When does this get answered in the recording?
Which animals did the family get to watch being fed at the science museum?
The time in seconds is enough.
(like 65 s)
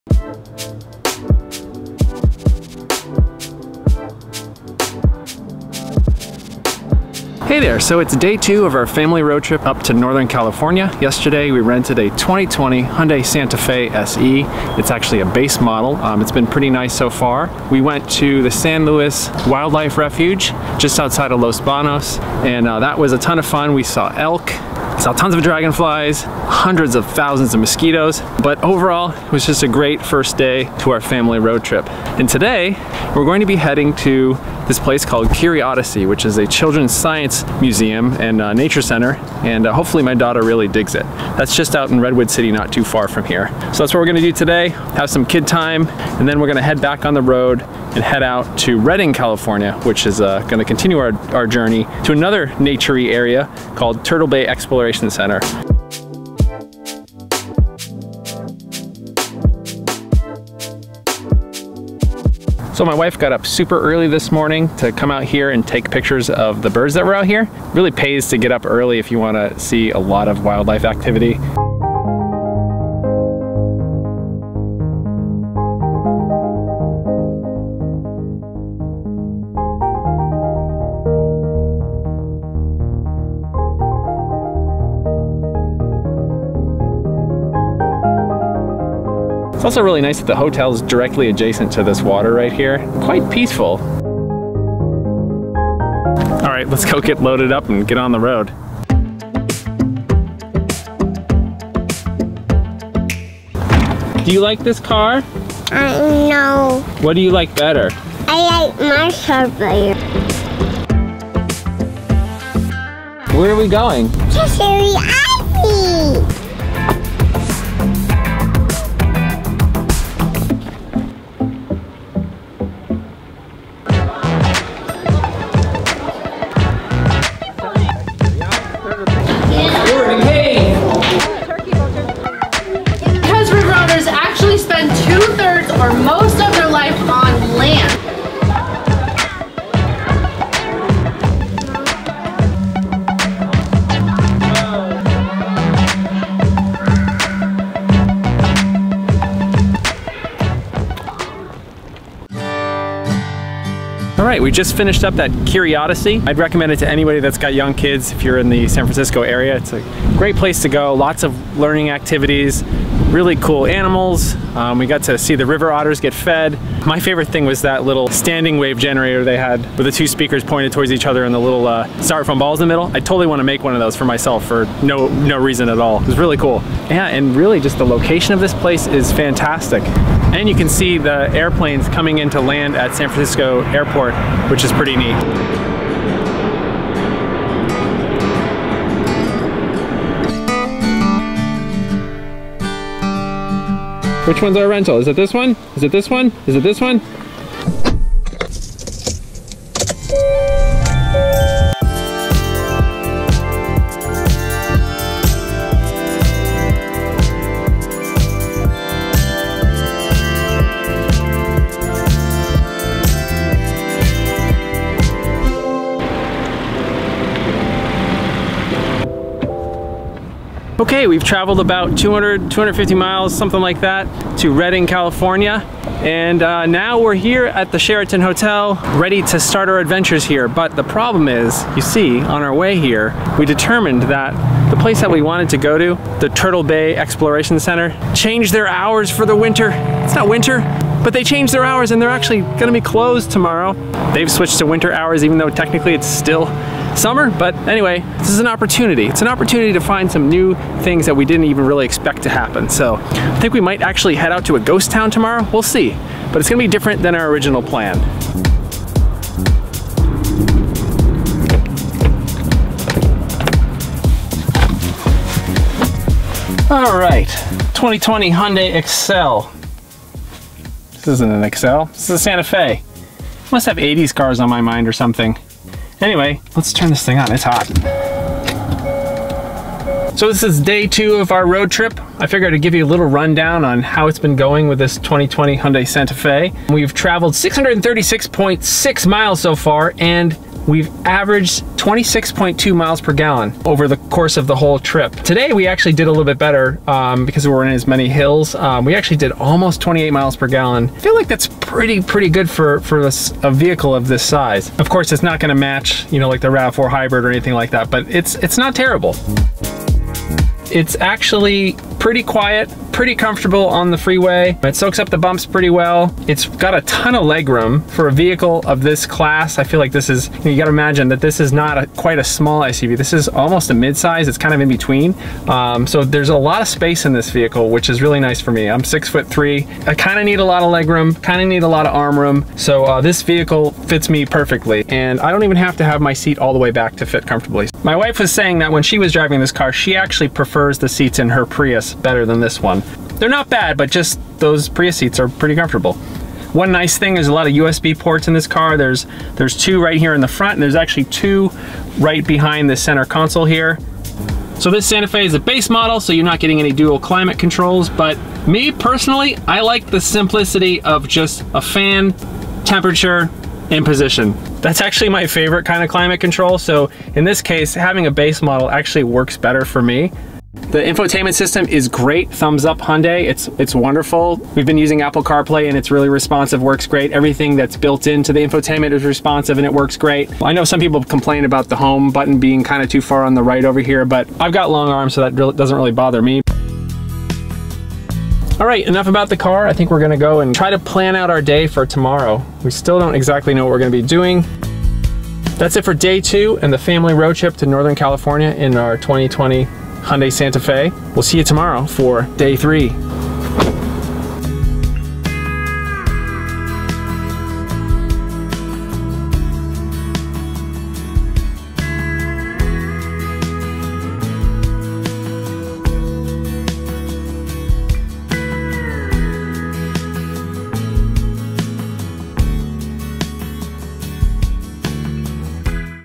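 165 s.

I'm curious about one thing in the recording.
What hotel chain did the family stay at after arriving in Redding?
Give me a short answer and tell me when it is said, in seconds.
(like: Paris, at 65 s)
Sheraton, at 227 s.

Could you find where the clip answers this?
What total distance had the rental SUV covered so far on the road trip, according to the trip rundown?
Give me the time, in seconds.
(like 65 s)
287 s.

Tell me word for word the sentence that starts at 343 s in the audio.
They're not bad, but just those Prius seats are pretty comfortable.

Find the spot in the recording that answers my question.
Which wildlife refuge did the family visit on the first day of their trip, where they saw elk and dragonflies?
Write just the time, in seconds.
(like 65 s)
18 s.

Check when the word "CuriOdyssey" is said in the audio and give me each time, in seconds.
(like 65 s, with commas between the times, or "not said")
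35 s, 155 s.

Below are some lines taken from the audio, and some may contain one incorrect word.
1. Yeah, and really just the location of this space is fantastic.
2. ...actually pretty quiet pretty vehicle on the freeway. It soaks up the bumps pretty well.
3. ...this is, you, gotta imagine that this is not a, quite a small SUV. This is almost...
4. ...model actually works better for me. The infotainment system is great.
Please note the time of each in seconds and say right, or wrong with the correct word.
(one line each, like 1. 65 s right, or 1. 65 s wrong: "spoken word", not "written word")
1. 176 s wrong: "place", not "space"
2. 310 s wrong: "comfortable", not "vehicle"
3. 319 s right
4. 368 s right.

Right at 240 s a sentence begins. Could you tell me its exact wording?
It's not winter, but they changed their hours and they're actually gonna be closed tomorrow.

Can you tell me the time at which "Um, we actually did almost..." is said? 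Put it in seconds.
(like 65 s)
298 s.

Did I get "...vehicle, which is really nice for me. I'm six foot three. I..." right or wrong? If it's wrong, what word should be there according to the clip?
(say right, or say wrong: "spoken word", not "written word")
right.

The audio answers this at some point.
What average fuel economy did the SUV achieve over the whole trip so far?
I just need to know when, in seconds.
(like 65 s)
291 s.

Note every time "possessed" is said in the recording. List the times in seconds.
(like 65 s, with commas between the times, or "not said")
not said.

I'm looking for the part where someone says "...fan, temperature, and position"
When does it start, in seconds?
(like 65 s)
361 s.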